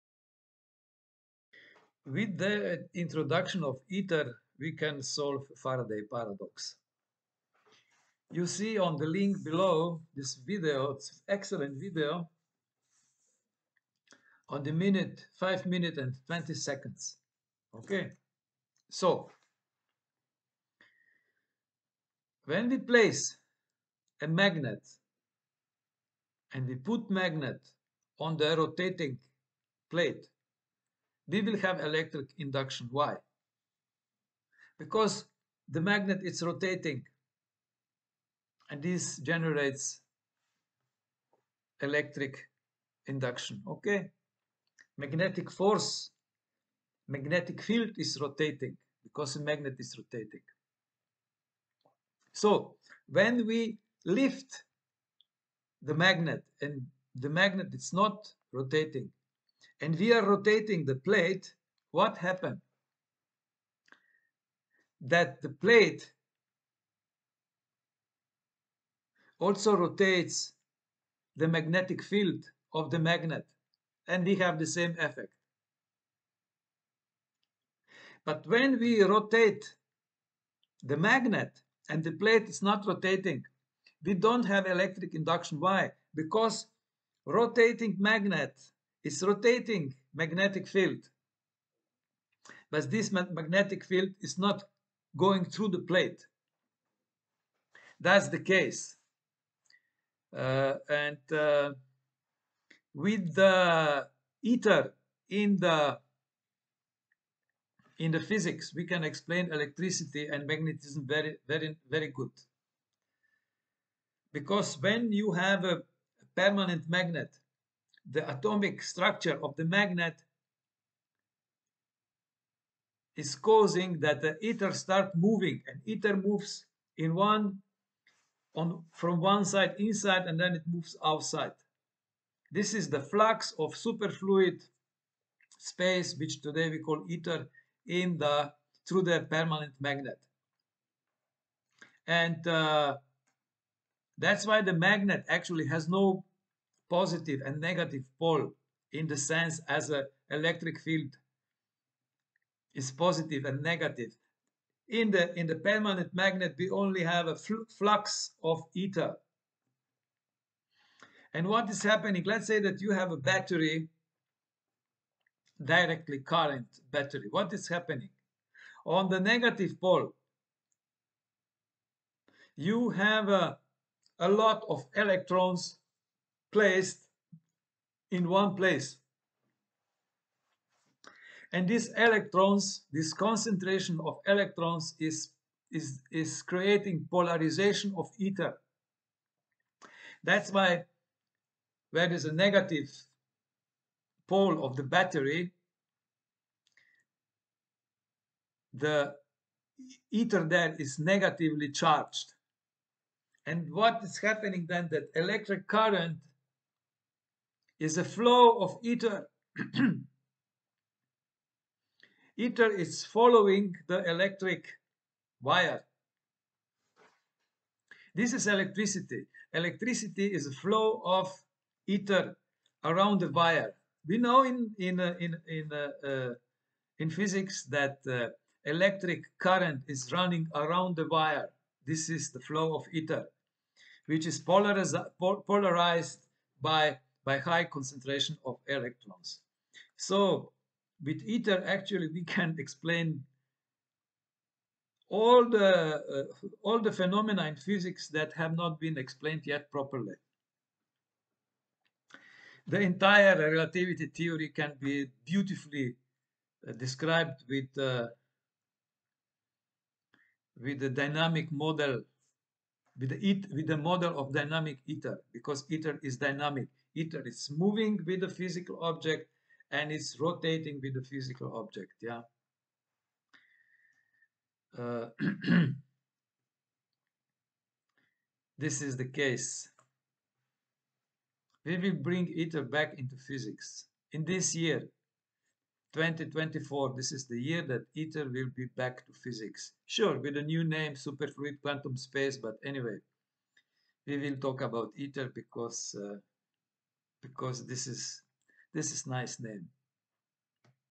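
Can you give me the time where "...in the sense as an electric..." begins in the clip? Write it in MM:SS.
02:28.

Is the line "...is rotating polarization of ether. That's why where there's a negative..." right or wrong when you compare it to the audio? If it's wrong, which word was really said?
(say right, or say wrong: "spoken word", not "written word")
wrong: "creating", not "rotating".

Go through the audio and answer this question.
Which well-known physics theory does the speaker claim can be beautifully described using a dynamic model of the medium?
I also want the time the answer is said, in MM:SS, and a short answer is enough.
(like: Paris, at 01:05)
Relativity theory, at 04:13.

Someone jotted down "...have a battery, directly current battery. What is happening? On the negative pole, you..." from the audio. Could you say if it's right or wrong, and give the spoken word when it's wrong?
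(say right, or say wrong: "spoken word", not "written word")
right.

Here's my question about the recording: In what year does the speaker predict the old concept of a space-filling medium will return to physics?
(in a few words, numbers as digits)
2024.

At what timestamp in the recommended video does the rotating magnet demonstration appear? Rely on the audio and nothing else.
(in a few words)
5 minutes and 20 seconds.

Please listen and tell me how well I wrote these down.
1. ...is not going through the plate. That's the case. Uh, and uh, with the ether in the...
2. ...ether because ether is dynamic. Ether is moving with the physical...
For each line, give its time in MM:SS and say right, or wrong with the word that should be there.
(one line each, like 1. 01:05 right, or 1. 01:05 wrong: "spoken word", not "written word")
1. 01:34 right
2. 04:24 right.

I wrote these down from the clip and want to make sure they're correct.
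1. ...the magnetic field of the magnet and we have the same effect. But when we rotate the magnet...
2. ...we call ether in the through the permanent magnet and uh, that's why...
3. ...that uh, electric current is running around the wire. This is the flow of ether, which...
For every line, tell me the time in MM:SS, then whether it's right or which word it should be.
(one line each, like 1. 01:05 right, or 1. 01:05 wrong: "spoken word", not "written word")
1. 01:11 right
2. 02:16 right
3. 03:47 right.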